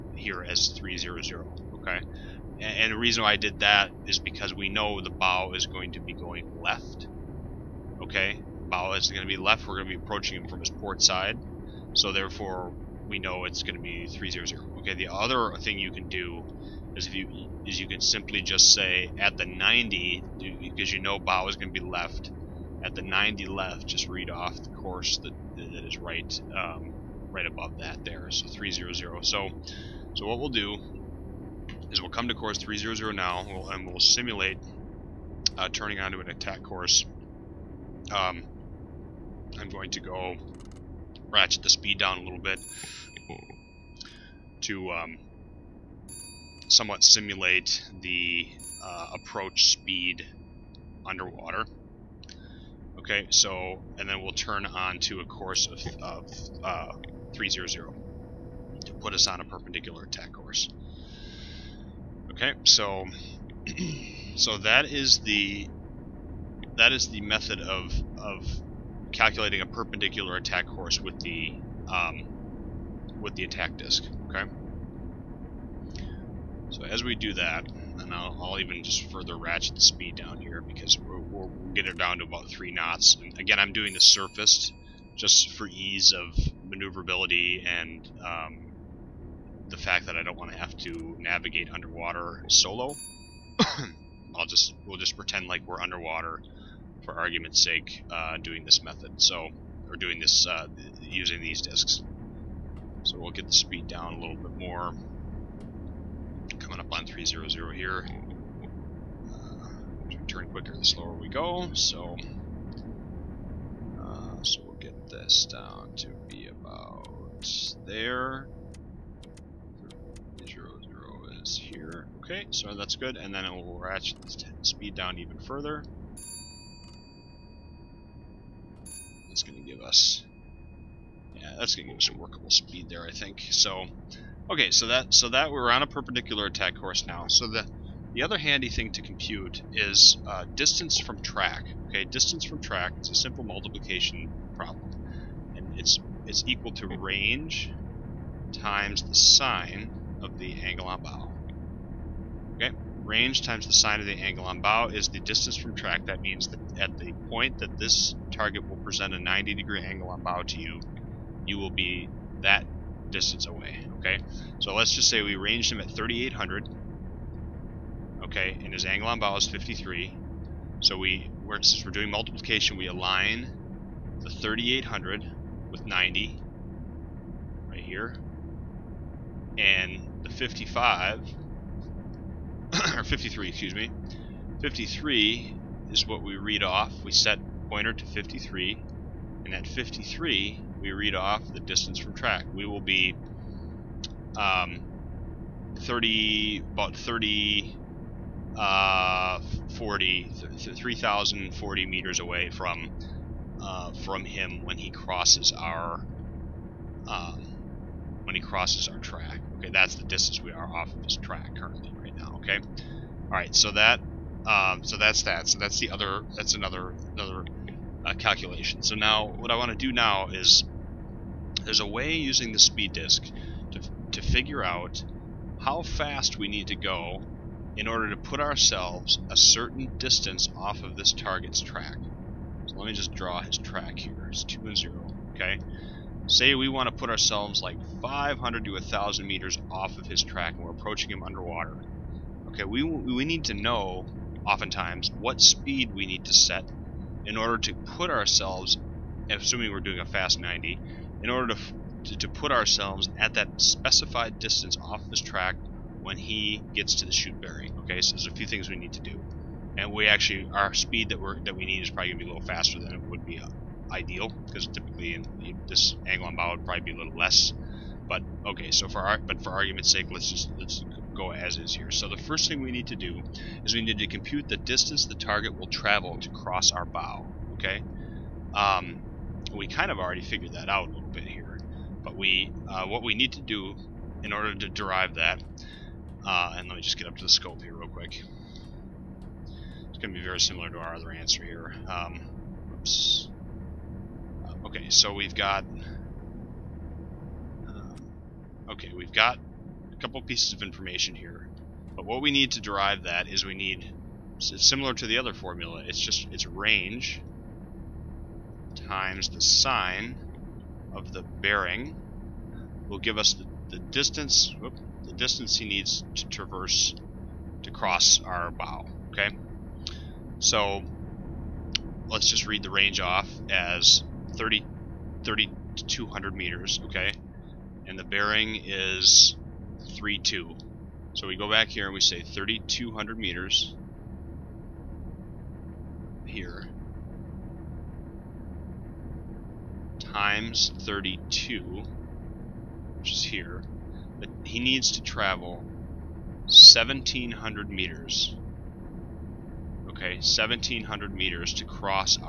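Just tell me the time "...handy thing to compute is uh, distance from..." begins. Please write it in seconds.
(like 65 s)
138 s.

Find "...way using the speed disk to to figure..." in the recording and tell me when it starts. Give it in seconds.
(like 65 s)
221 s.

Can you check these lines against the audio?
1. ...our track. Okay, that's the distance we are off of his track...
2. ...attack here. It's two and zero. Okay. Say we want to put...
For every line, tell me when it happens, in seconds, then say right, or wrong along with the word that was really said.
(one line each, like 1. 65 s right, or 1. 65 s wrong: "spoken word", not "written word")
1. 208 s right
2. 233 s wrong: "track", not "attack".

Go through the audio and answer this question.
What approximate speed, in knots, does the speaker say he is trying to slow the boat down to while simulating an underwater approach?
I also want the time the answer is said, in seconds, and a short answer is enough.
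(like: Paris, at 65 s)
3 knots, at 82 s.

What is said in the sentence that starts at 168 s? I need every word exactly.
Okay, and his angle on bow is 53.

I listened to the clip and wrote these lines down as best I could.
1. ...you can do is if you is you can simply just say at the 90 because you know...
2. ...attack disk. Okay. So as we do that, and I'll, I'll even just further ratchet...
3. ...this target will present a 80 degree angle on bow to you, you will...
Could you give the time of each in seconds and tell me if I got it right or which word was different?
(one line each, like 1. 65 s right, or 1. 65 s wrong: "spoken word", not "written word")
1. 15 s right
2. 73 s right
3. 157 s wrong: "90", not "80".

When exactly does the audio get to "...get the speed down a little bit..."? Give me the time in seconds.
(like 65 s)
103 s.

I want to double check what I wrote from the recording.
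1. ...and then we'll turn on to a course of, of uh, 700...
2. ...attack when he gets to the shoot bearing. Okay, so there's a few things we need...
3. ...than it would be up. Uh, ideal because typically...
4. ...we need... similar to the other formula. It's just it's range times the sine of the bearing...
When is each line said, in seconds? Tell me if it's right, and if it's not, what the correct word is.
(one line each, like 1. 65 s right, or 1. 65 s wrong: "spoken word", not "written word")
1. 53 s wrong: "300", not "700"
2. 255 s wrong: "track", not "attack"
3. 262 s right
4. 303 s right.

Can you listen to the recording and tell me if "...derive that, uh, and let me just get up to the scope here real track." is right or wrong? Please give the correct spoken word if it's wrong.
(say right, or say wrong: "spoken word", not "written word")
wrong: "quick", not "track".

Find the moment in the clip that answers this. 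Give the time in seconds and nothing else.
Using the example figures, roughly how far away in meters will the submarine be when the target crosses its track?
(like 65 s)
200 s.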